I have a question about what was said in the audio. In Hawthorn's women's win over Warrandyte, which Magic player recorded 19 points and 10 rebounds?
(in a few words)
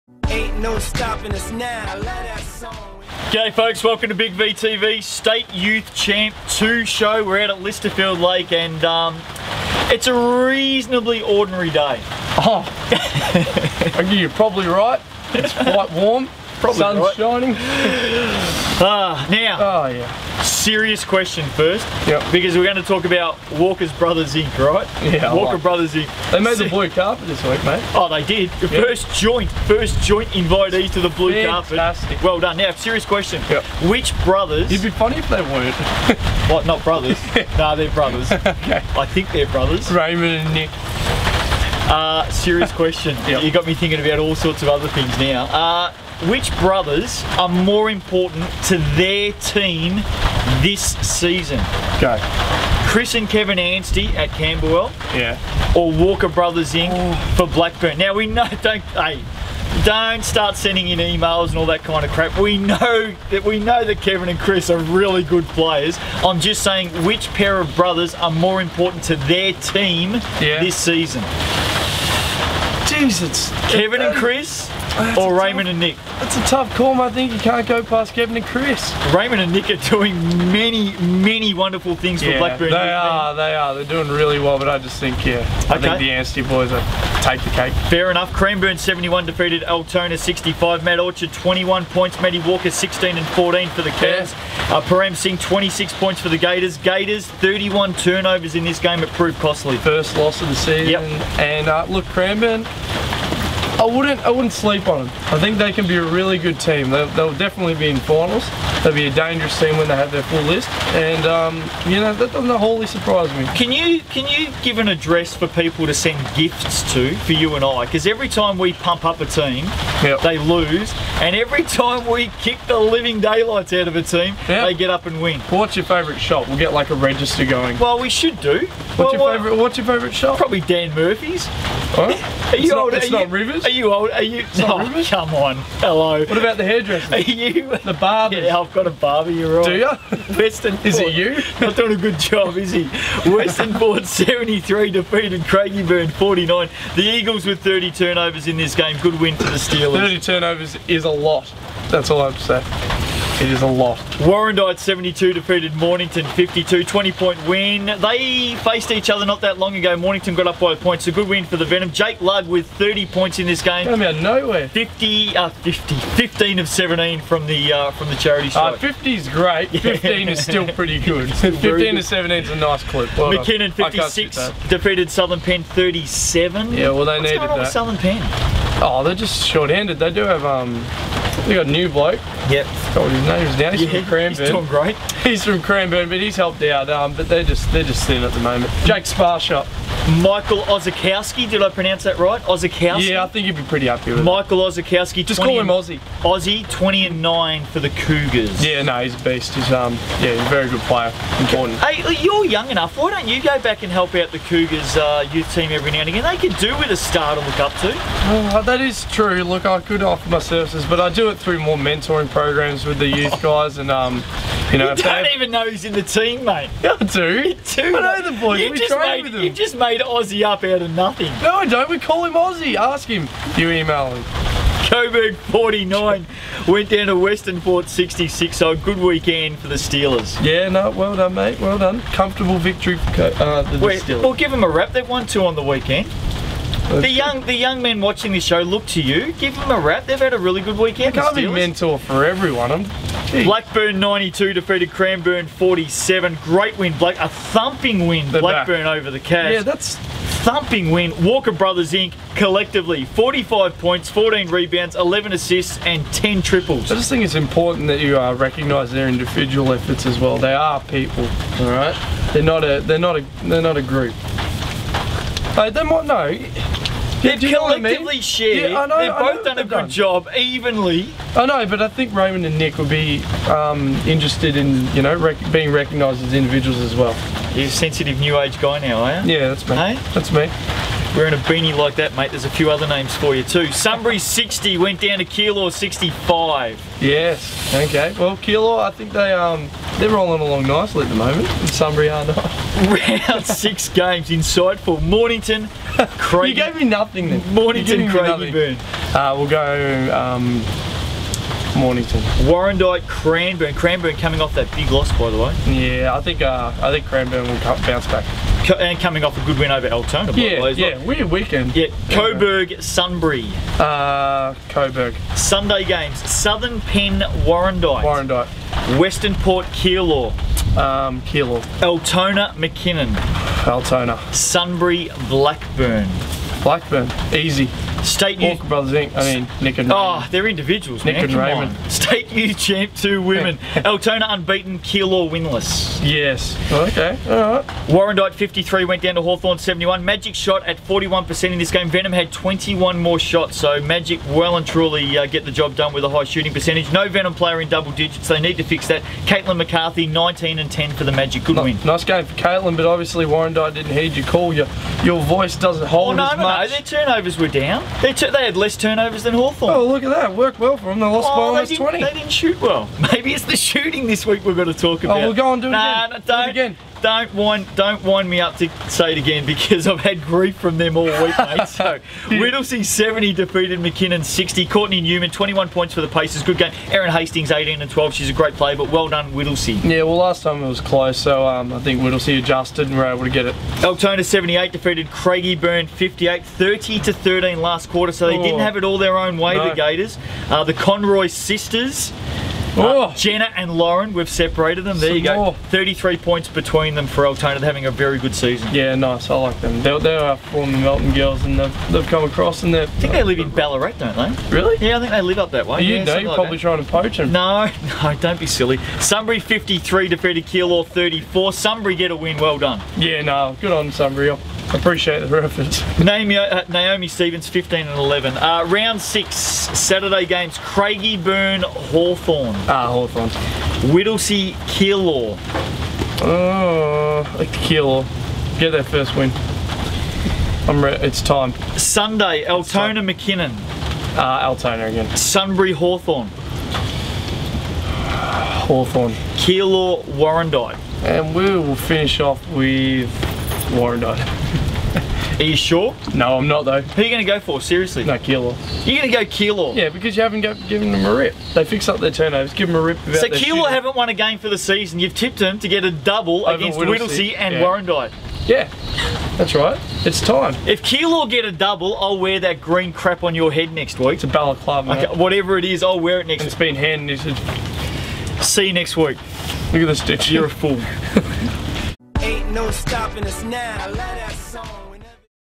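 Caitlin McCarthy.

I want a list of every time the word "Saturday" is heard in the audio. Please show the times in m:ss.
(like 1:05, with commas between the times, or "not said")
6:59.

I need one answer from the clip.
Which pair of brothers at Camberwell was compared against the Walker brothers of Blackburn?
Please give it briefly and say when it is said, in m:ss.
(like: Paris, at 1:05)
Chris and Kevin Anstey, at 0:52.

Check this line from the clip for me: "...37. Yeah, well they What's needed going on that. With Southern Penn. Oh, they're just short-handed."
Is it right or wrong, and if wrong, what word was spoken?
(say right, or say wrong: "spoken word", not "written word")
right.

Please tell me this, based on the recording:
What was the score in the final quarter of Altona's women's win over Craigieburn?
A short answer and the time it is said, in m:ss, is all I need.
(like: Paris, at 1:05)
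30 to 13, at 6:26.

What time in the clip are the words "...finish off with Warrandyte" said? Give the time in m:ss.
7:21.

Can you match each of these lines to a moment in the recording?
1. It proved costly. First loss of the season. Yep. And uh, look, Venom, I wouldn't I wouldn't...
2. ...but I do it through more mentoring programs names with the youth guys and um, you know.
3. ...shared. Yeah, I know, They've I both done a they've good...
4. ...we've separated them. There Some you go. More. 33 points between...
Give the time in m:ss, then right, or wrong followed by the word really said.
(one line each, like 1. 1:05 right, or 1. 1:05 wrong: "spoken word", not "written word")
1. 1:39 wrong: "Cranbourne", not "Venom"
2. 3:30 wrong: "games", not "names"
3. 4:28 right
4. 6:34 right.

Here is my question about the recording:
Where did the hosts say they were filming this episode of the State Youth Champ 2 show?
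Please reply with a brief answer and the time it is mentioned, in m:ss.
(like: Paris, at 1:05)
Lysterfield Lake, at 0:07.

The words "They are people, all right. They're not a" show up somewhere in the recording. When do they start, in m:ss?
4:20.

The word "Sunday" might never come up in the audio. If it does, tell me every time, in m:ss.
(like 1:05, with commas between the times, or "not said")
5:15, 7:11.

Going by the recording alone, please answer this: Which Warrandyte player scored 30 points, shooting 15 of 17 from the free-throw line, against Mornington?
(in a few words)
Jake Ludd.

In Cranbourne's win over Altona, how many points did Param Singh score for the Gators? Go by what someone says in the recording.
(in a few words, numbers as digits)
26.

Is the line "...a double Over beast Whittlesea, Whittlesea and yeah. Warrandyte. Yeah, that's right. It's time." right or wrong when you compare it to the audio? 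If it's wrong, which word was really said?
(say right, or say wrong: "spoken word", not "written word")
wrong: "against", not "beast".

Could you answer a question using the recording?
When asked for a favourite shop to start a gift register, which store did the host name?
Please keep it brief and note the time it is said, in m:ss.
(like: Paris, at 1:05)
Dan Murphy's, at 2:10.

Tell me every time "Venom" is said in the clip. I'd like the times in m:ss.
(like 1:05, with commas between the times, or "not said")
2:41, 5:41, 5:47.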